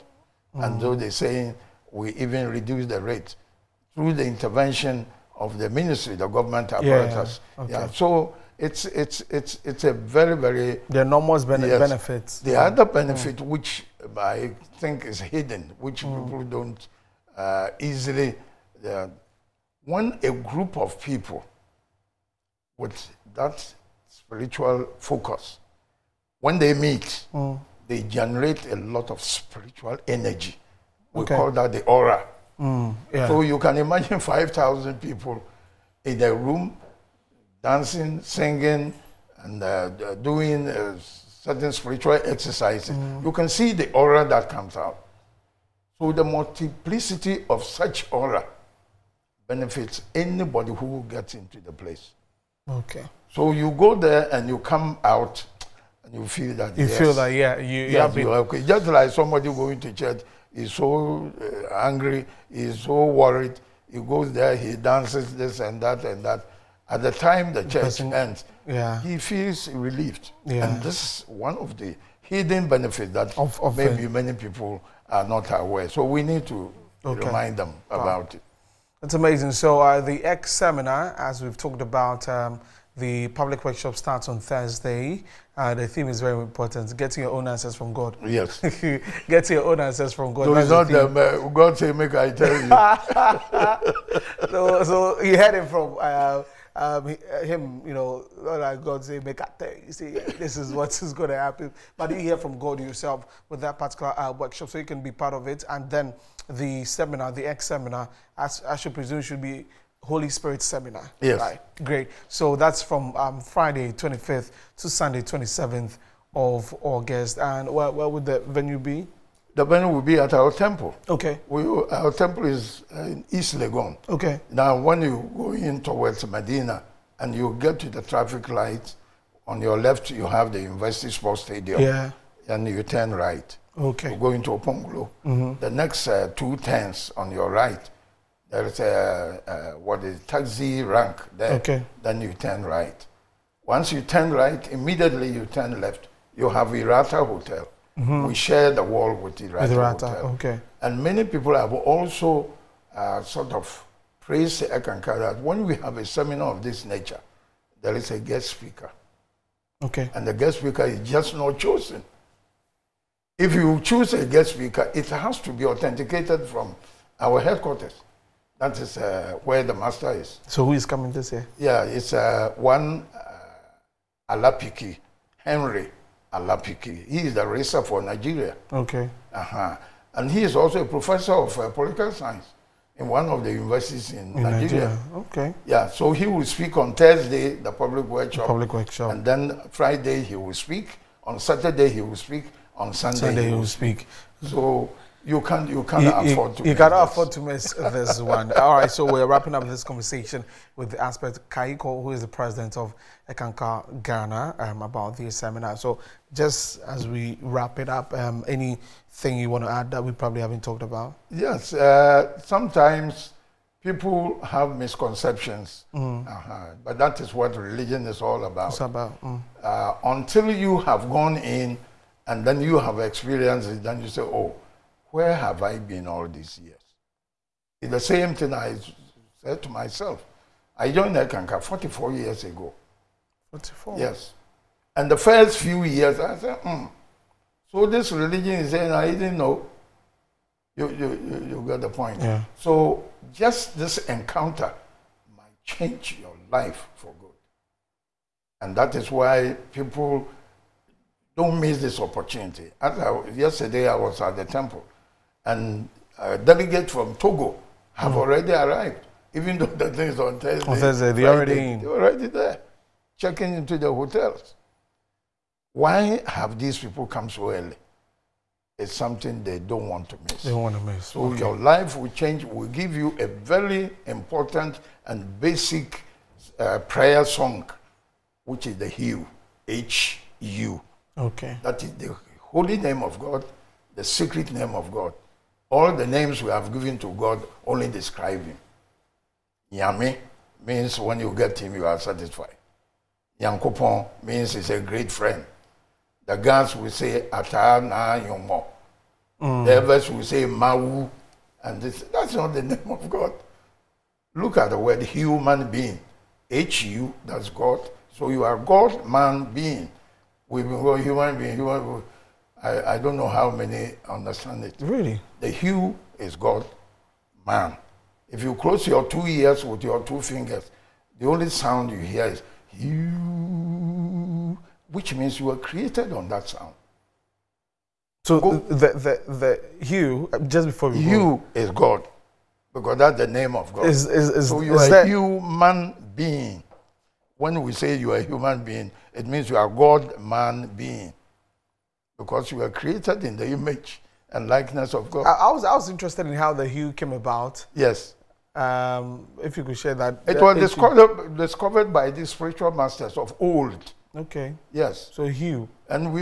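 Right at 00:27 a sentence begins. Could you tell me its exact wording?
they generate a lot of spiritual energy.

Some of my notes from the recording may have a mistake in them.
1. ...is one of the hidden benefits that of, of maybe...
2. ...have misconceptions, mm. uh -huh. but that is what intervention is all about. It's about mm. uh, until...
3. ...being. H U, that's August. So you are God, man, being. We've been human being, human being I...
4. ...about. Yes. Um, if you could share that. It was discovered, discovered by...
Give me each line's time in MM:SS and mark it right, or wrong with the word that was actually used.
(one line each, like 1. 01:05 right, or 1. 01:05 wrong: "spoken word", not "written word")
1. 01:11 right
2. 03:34 wrong: "religion", not "intervention"
3. 05:05 wrong: "God", not "August"
4. 05:47 right.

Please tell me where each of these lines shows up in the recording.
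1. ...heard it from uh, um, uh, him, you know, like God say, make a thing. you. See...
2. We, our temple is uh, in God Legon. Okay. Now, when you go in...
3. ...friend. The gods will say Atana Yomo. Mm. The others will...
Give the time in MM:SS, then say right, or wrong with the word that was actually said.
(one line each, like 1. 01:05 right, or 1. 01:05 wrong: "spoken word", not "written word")
1. 01:35 right
2. 02:01 wrong: "East", not "God"
3. 04:55 right.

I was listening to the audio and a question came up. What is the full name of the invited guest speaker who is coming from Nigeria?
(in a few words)
Henry Alapiki.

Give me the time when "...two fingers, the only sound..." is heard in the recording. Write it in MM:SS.
05:20.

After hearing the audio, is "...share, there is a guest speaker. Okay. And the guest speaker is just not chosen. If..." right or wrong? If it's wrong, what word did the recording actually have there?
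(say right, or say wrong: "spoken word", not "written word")
wrong: "nature", not "share".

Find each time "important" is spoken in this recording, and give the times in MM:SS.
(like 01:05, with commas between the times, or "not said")
01:26, 04:34.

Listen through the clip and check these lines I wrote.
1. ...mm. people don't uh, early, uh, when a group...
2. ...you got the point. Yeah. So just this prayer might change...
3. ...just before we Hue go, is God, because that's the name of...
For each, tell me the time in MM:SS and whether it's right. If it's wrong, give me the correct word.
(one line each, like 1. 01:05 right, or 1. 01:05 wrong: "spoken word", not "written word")
1. 00:16 wrong: "easily", not "early"
2. 04:01 wrong: "encounter", not "prayer"
3. 05:30 right.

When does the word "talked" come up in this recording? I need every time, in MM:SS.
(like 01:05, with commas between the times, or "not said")
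01:21, 03:30.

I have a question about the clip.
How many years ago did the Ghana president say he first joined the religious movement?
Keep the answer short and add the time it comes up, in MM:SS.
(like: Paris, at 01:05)
44 years, at 03:51.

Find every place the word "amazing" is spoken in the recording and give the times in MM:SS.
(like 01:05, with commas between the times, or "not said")
01:19.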